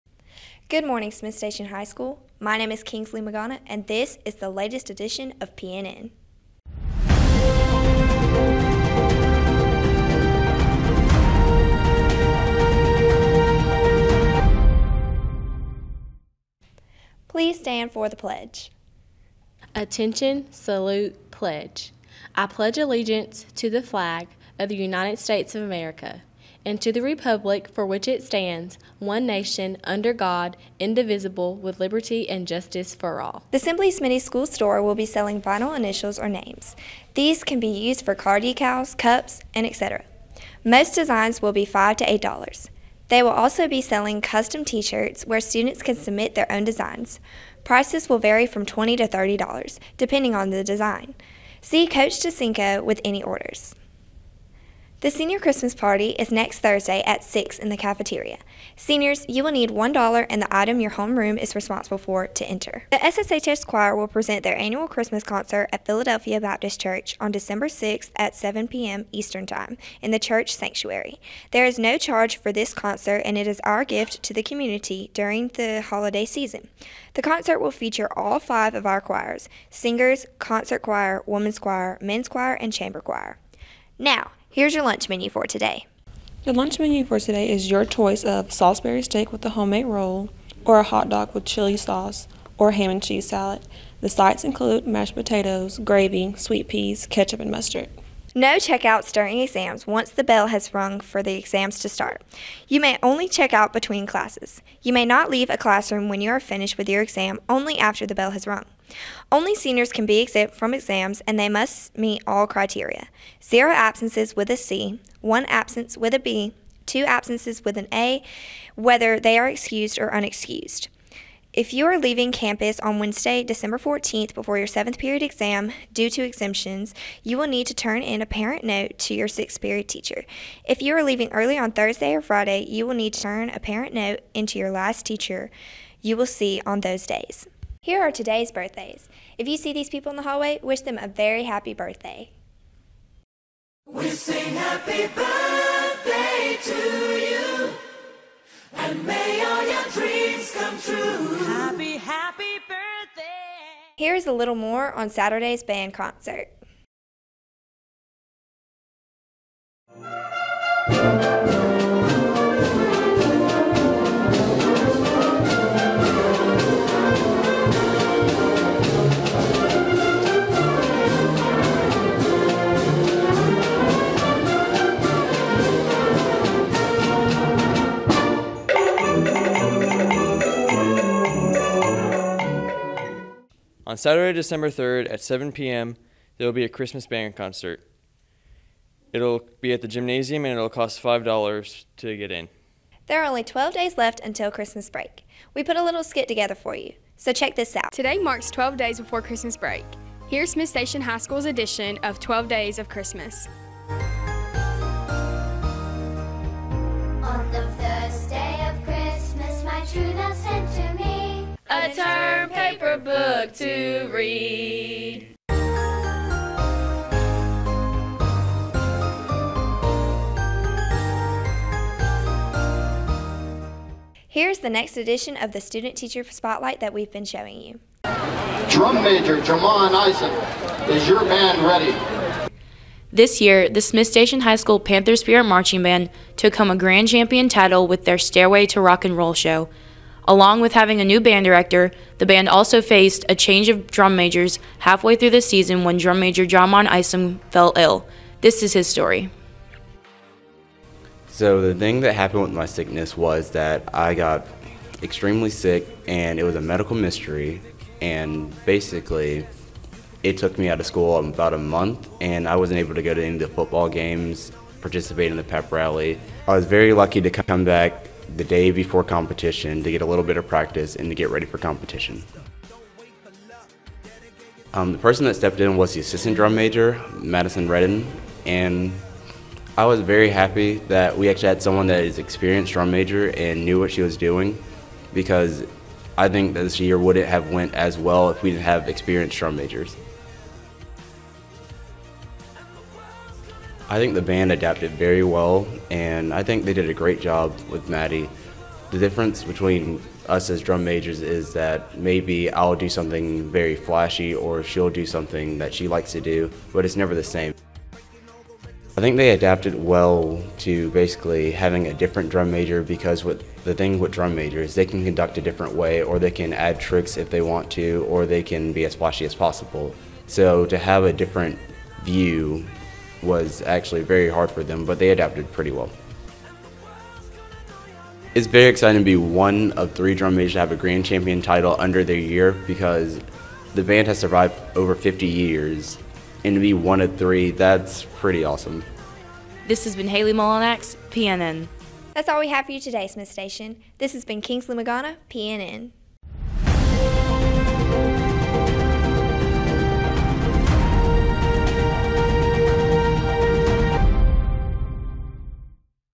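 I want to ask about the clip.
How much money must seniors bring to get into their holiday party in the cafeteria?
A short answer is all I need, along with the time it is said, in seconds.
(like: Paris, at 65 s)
$1, at 59 s.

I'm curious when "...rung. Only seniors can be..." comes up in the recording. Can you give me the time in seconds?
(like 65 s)
108 s.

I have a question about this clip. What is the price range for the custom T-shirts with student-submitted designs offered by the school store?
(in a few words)
$20 to $30.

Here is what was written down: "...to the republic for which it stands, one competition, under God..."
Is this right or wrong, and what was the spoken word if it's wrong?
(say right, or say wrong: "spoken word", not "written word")
wrong: "nation", not "competition".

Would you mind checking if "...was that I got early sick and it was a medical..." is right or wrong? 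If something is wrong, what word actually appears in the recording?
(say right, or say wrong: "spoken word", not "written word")
wrong: "extremely", not "early".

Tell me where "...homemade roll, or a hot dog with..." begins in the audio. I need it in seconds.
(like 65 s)
89 s.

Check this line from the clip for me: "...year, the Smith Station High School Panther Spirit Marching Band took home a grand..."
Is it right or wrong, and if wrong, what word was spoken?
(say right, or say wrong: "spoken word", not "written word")
right.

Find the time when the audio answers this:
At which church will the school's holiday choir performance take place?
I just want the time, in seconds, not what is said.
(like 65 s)
65 s.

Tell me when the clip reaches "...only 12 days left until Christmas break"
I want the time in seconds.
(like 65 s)
193 s.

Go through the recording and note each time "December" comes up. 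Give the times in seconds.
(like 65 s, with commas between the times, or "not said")
67 s, 123 s, 184 s.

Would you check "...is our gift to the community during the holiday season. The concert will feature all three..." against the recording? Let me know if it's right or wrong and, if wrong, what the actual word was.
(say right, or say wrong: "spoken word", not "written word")
wrong: "five", not "three".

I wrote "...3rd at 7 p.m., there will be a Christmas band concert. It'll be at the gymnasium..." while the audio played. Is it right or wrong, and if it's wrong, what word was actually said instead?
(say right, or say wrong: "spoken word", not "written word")
right.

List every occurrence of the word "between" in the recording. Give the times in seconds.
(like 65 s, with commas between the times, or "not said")
103 s, 299 s.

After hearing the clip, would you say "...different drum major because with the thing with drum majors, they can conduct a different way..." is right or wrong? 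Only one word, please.
right.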